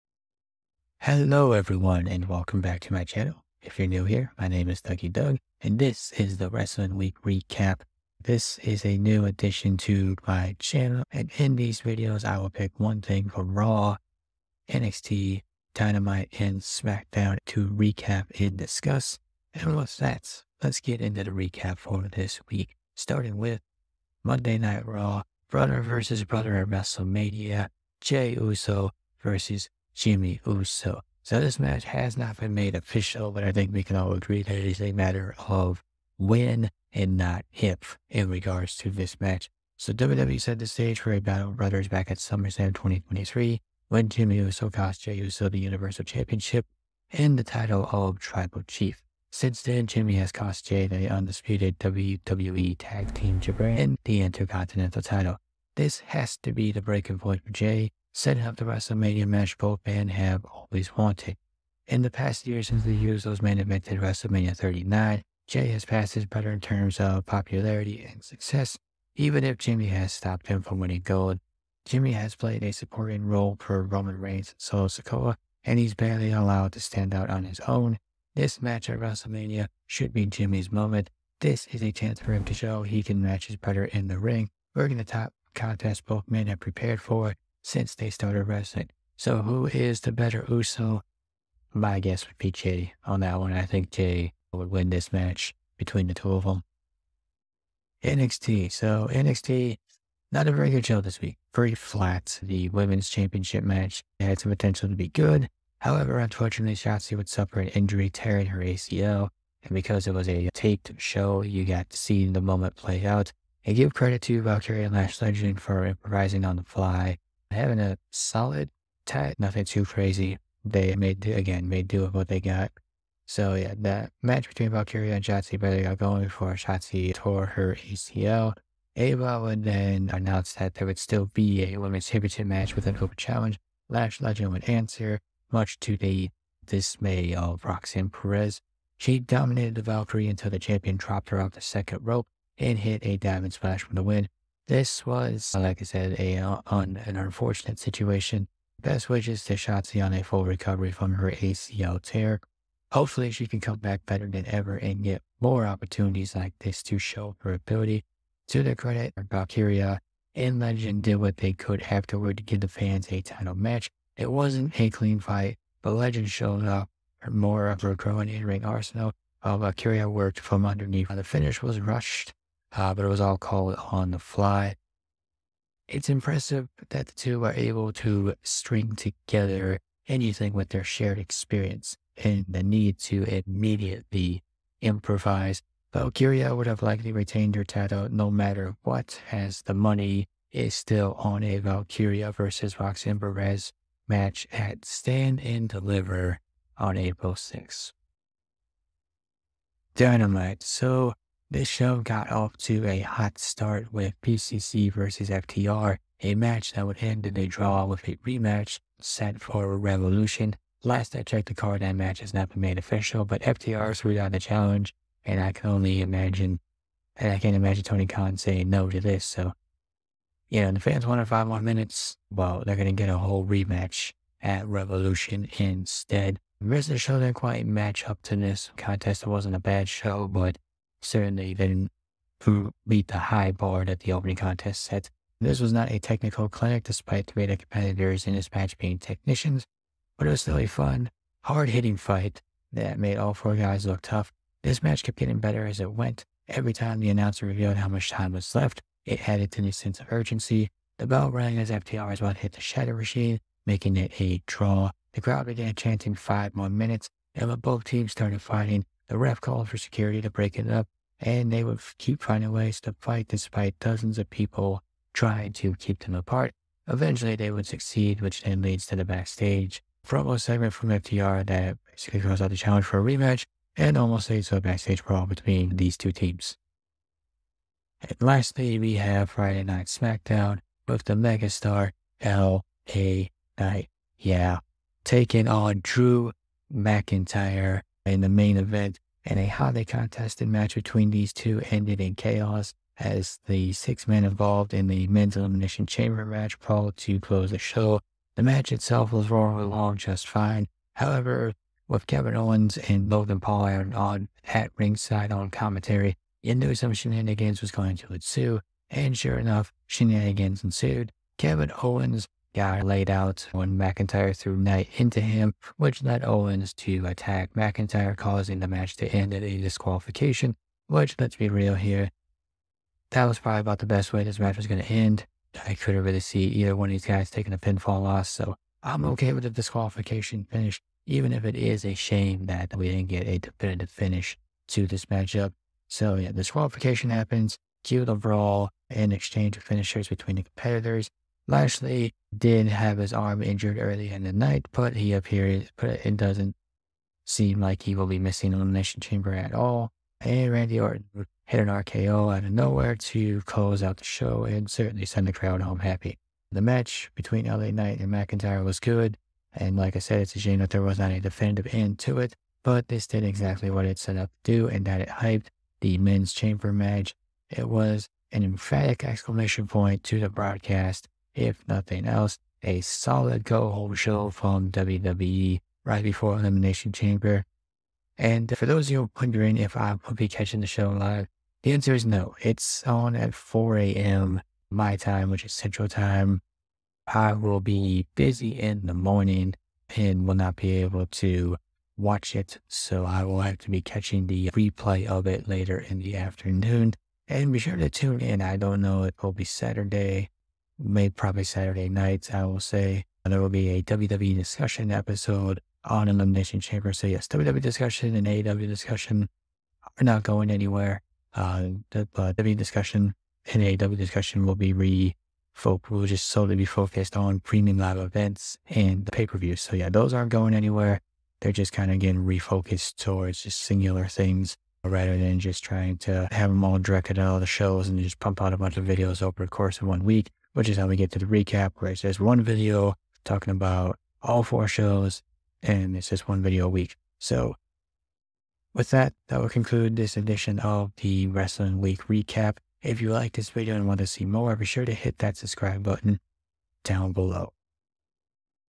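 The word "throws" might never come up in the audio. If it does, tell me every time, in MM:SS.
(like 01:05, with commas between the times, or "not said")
04:32.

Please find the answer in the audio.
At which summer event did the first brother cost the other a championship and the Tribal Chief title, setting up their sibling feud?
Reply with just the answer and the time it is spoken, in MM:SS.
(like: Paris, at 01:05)
SummerSlam 2023, at 00:42.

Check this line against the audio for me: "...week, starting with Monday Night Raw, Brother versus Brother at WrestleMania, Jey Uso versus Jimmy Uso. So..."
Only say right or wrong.
right.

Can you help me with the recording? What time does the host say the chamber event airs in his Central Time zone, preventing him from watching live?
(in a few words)
4 a.m.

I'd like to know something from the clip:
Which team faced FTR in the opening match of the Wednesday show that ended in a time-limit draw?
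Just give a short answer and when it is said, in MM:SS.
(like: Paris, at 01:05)
BCC, at 03:24.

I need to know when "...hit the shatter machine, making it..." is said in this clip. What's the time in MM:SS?
04:12.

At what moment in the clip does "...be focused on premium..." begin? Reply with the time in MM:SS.
06:56.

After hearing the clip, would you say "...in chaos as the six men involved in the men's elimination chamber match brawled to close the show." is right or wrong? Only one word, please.
right.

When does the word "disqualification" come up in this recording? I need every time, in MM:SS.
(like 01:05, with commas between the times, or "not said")
05:19, 05:29, 05:36.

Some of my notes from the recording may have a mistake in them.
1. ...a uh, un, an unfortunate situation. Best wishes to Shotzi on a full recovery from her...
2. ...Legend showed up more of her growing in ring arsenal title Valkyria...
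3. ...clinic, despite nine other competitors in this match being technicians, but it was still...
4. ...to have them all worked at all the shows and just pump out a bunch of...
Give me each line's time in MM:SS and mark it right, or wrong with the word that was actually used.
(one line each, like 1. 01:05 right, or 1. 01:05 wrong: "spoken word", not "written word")
1. 02:26 right
2. 02:45 wrong: "while", not "title"
3. 03:56 wrong: "three", not "nine"
4. 07:05 wrong: "directed", not "worked".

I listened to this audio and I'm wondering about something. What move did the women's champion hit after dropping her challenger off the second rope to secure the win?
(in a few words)
diamond splash.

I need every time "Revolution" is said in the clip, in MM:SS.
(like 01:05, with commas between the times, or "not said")
03:29, 03:44.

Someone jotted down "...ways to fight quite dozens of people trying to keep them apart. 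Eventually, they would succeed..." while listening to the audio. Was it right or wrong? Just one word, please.
wrong.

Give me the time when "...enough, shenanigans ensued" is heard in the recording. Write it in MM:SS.
05:09.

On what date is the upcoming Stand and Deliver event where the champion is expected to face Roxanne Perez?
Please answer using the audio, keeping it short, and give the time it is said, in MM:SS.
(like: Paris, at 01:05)
April 6, at 03:16.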